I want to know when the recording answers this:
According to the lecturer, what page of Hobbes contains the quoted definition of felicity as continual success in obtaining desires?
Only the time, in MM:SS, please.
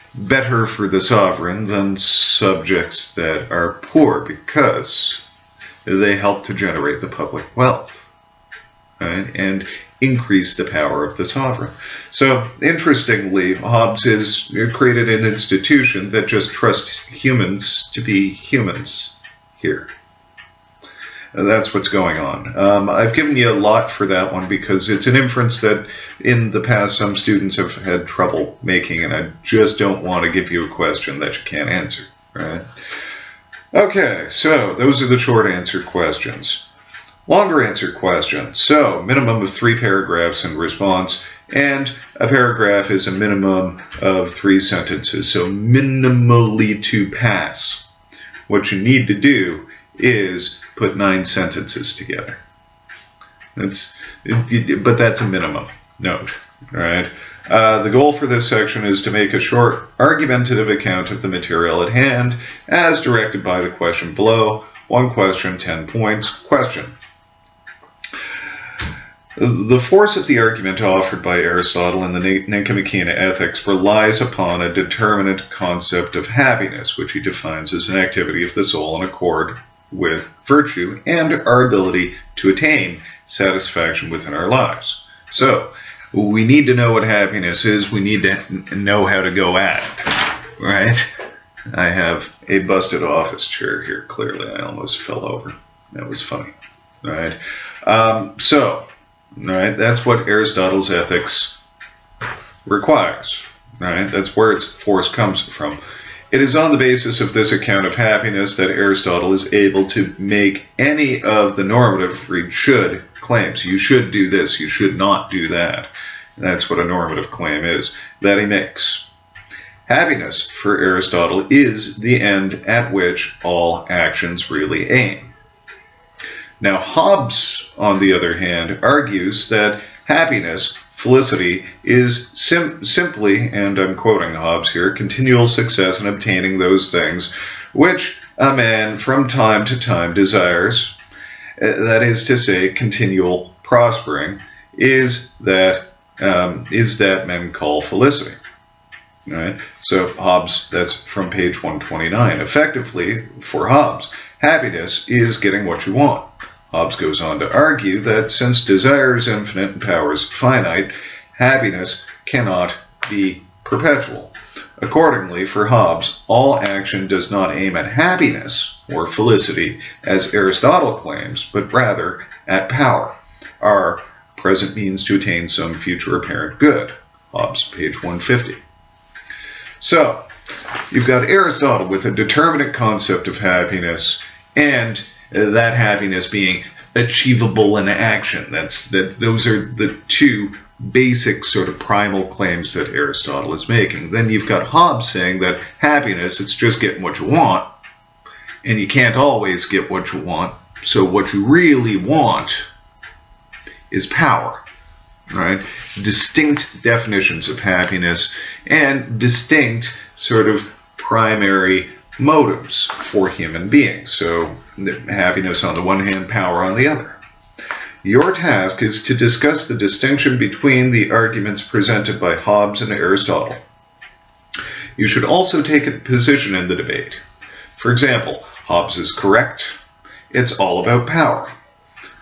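02:31.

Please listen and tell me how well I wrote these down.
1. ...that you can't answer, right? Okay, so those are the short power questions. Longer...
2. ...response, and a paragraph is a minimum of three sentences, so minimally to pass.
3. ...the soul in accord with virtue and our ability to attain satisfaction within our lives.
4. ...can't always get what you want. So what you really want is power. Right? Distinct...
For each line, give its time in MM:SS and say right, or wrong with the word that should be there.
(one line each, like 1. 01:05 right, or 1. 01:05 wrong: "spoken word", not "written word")
1. 00:31 wrong: "answer", not "power"
2. 00:40 right
3. 01:18 right
4. 03:18 right.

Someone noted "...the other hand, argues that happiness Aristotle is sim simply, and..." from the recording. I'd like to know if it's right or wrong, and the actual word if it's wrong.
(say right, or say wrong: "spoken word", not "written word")
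wrong: "Felicity", not "Aristotle".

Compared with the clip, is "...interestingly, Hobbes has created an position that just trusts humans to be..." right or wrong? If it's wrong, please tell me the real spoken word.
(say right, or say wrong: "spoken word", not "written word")
wrong: "institution", not "position".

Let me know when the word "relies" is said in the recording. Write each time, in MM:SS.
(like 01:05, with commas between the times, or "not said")
01:13.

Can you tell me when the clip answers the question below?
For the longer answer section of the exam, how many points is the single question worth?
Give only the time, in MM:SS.
01:05.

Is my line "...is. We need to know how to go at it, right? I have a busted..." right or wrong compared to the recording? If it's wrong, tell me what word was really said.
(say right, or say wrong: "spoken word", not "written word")
right.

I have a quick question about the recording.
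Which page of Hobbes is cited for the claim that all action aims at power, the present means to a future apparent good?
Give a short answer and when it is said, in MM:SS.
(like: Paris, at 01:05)
150, at 02:57.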